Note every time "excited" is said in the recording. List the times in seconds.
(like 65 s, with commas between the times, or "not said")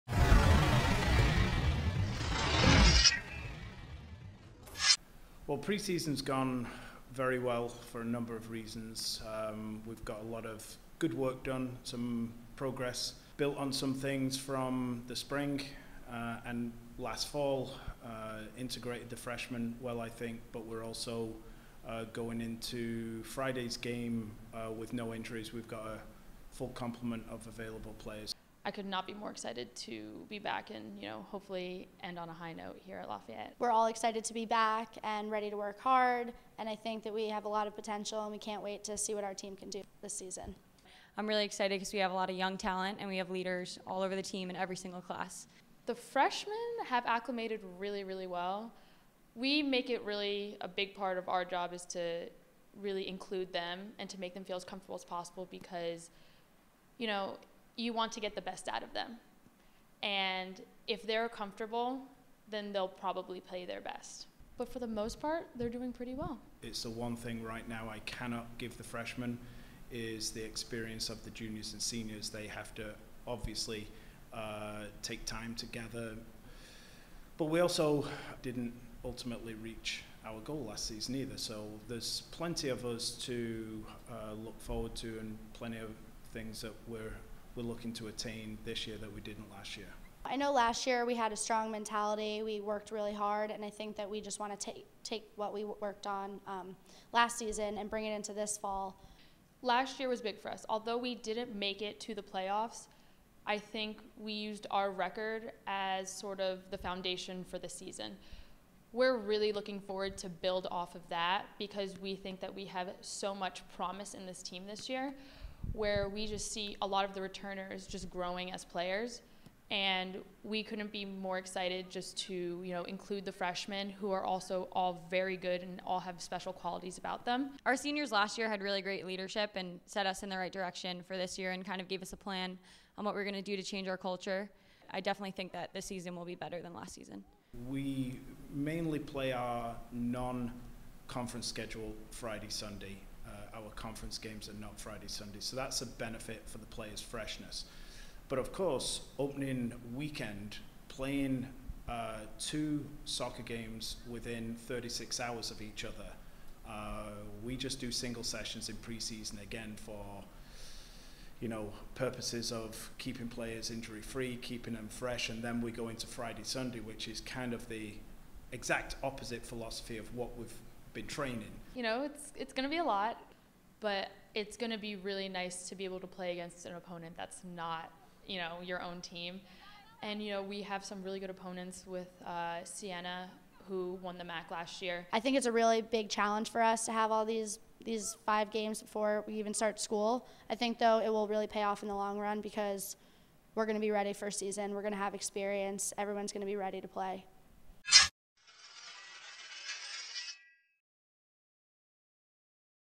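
29 s, 33 s, 41 s, 121 s.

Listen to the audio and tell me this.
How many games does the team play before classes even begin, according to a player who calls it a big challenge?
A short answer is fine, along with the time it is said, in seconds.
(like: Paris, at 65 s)
5, at 188 s.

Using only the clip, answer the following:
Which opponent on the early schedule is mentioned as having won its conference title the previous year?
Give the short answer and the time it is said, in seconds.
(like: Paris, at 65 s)
Siena, at 182 s.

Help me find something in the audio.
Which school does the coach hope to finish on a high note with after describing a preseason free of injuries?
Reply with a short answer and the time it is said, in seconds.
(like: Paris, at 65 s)
Lafayette, at 33 s.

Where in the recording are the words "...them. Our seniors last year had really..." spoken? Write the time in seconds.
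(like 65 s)
127 s.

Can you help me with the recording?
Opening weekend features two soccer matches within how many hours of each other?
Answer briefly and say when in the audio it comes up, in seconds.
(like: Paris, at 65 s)
36 hours, at 154 s.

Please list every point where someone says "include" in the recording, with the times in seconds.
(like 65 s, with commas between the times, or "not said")
53 s, 122 s.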